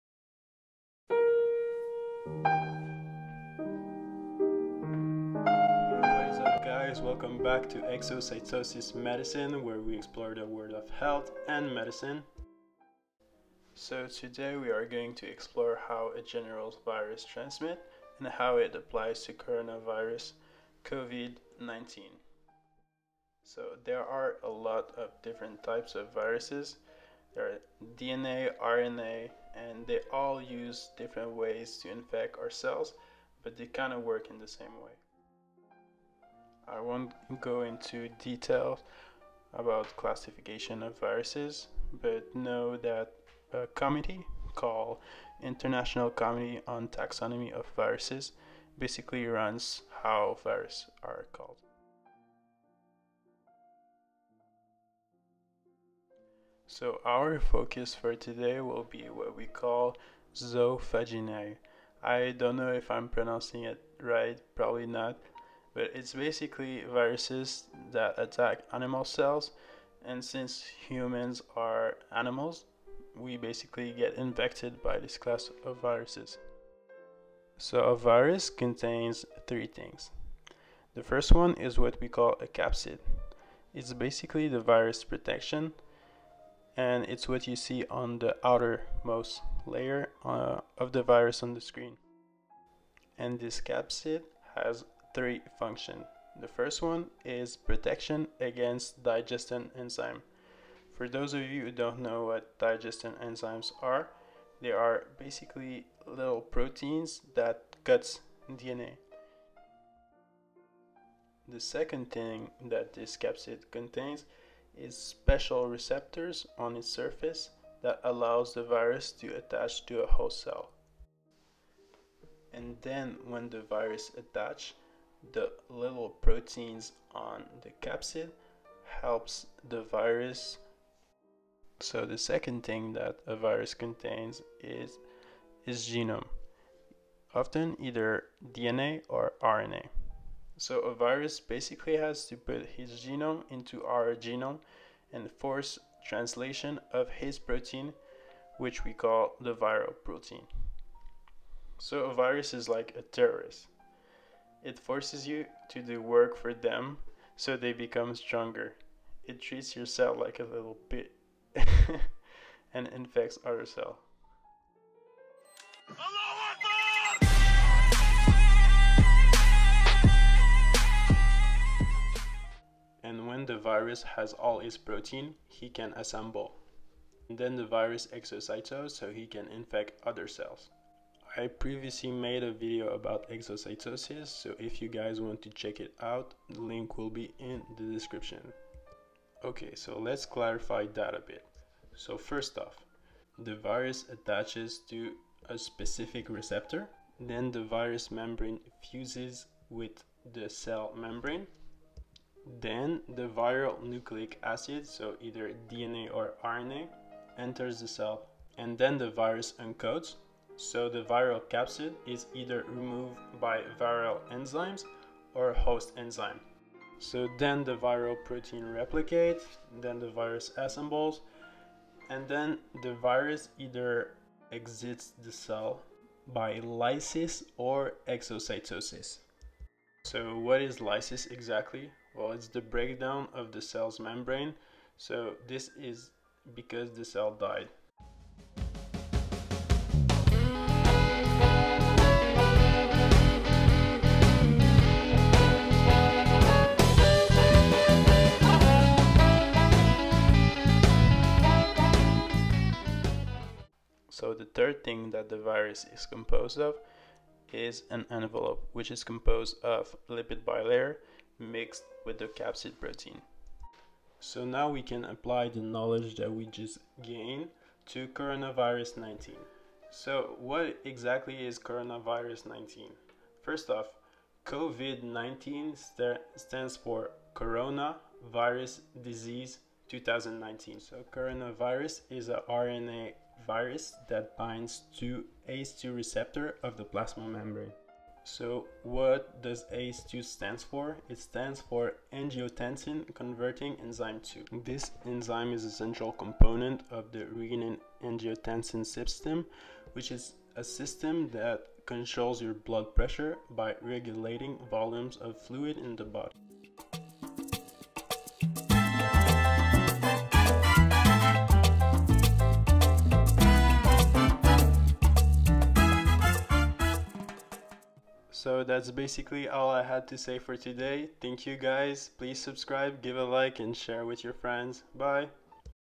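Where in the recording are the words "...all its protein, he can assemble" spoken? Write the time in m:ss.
2:54.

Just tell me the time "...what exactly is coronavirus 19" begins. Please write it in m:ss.
4:30.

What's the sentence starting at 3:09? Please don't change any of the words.
Okay, so let's clarify that a bit.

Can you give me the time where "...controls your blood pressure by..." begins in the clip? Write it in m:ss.
5:01.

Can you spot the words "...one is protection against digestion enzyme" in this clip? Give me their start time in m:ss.
1:36.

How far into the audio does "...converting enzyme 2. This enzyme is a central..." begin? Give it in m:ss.
4:53.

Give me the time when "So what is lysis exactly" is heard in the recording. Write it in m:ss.
3:50.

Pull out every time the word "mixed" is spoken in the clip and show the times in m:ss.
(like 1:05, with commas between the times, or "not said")
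4:21.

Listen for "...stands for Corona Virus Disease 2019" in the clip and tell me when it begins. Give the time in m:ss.
4:36.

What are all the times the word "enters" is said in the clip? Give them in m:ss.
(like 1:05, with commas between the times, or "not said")
3:27.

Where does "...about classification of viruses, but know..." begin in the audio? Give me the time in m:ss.
0:39.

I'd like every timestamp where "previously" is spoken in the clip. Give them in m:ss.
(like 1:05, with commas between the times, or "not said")
3:01.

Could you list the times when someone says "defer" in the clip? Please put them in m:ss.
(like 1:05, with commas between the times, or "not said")
not said.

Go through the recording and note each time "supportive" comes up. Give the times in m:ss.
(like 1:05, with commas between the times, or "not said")
not said.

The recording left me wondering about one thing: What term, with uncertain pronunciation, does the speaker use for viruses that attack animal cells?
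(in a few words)
zoophagy.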